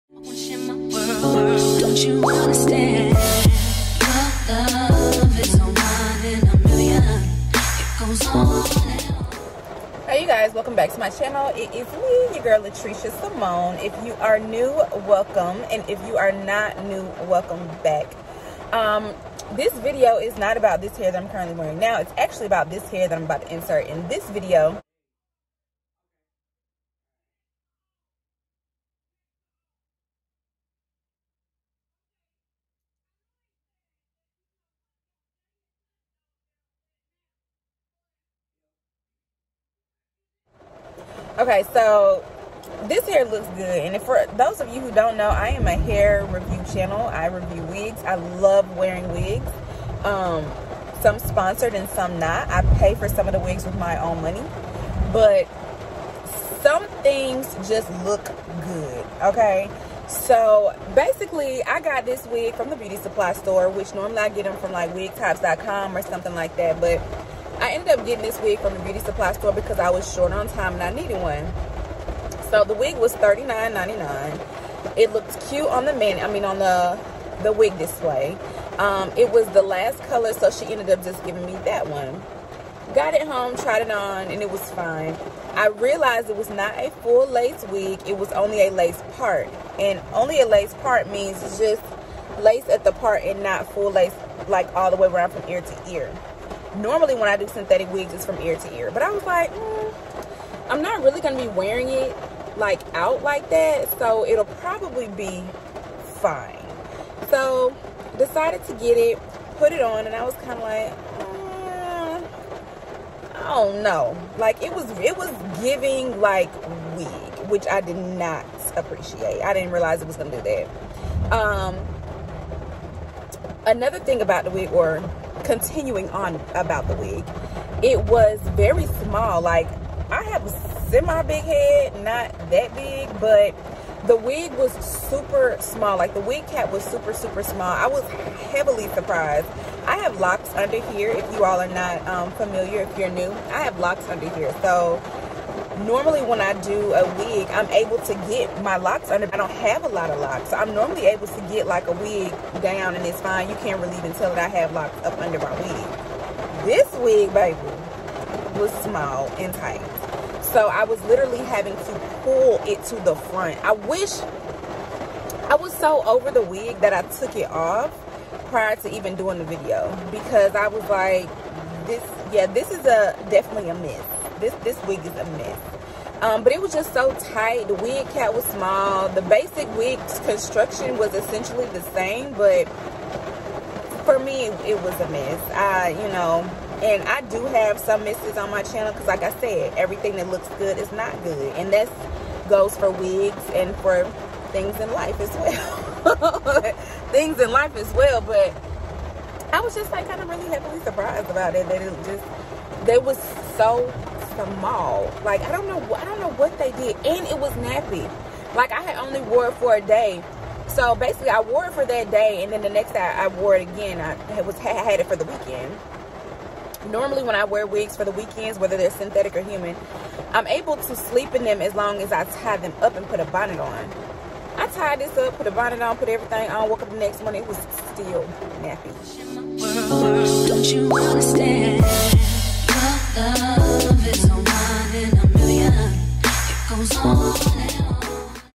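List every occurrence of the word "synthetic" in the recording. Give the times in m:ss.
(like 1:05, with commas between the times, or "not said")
1:37, 3:38.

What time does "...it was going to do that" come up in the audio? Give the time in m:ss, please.
2:00.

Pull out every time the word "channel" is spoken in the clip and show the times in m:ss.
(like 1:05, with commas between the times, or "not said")
0:11, 0:46, 3:08.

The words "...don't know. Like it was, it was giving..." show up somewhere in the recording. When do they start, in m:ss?
1:53.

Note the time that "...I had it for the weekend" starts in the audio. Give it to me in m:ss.
3:34.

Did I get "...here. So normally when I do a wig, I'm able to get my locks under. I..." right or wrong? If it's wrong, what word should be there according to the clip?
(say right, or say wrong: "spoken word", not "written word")
right.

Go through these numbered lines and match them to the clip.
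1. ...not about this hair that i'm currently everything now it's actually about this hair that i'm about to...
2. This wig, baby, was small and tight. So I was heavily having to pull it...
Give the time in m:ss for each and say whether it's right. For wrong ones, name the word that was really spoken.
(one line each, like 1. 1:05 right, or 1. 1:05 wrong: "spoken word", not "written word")
1. 0:20 wrong: "wearing", not "everything"
2. 2:36 wrong: "literally", not "heavily".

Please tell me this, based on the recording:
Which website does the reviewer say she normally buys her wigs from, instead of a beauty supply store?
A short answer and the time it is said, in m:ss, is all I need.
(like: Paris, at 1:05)
wigtypes.com, at 1:04.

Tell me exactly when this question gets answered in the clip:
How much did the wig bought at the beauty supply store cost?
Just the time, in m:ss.
1:13.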